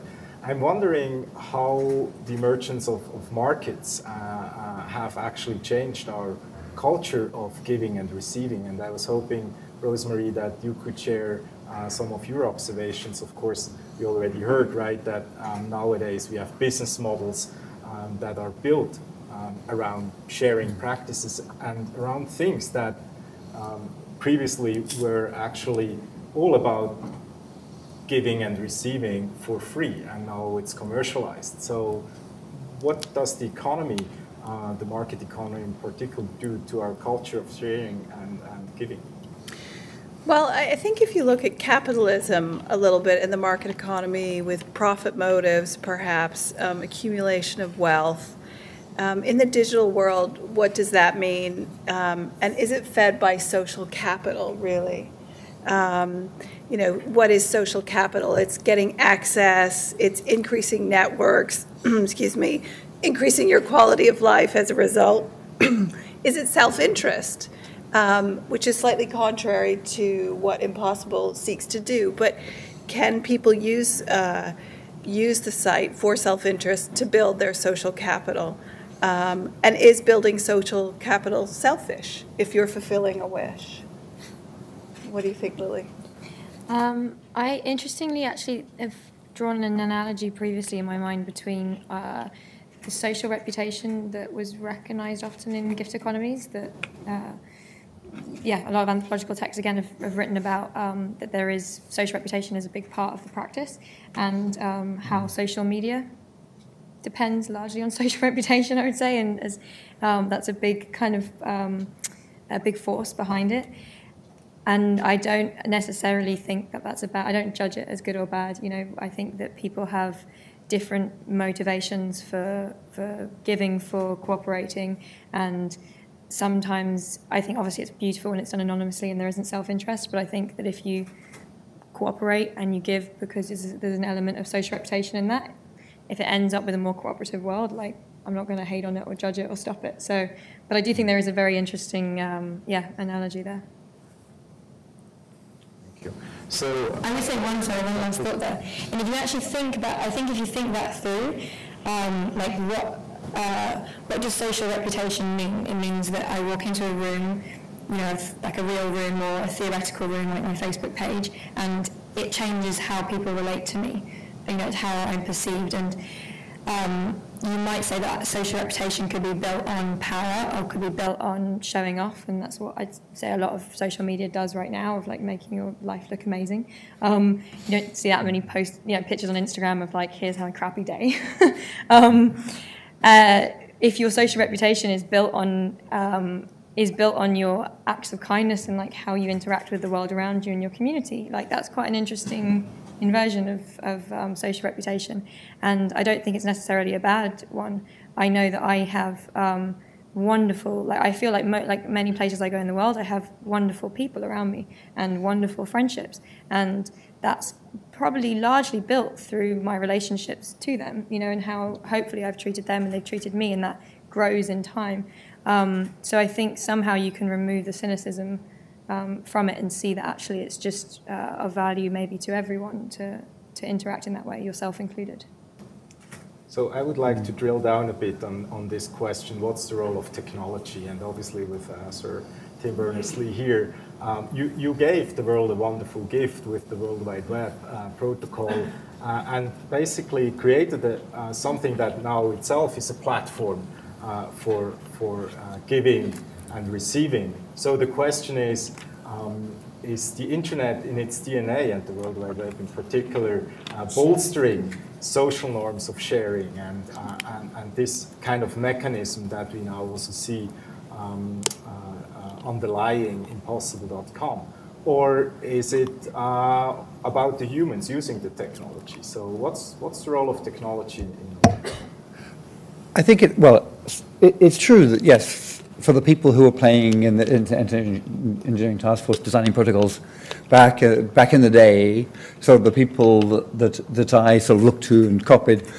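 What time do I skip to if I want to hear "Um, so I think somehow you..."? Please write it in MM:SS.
03:35.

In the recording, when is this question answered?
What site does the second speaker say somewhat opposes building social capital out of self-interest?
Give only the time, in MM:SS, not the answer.
01:10.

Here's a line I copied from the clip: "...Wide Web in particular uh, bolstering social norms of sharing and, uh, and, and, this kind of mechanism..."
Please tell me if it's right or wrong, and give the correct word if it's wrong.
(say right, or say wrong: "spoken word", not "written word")
right.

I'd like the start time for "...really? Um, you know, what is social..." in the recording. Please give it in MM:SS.
00:54.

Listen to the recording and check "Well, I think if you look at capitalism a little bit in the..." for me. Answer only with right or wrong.
right.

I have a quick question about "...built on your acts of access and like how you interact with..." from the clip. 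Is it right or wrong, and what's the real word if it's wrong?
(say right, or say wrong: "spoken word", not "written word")
wrong: "kindness", not "access".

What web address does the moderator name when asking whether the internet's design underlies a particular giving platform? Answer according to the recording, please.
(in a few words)
impossible.com.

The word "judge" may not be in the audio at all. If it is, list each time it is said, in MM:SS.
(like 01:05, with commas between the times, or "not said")
01:57, 02:19.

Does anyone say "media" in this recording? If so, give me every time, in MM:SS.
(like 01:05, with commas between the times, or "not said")
01:45, 02:54.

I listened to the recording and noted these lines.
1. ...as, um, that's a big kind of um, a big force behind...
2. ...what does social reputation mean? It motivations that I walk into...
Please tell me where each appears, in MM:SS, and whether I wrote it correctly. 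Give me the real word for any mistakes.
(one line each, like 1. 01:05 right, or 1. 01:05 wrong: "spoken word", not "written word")
1. 01:49 right
2. 02:34 wrong: "means", not "motivations".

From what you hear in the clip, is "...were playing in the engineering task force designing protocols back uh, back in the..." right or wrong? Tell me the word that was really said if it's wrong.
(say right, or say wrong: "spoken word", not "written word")
right.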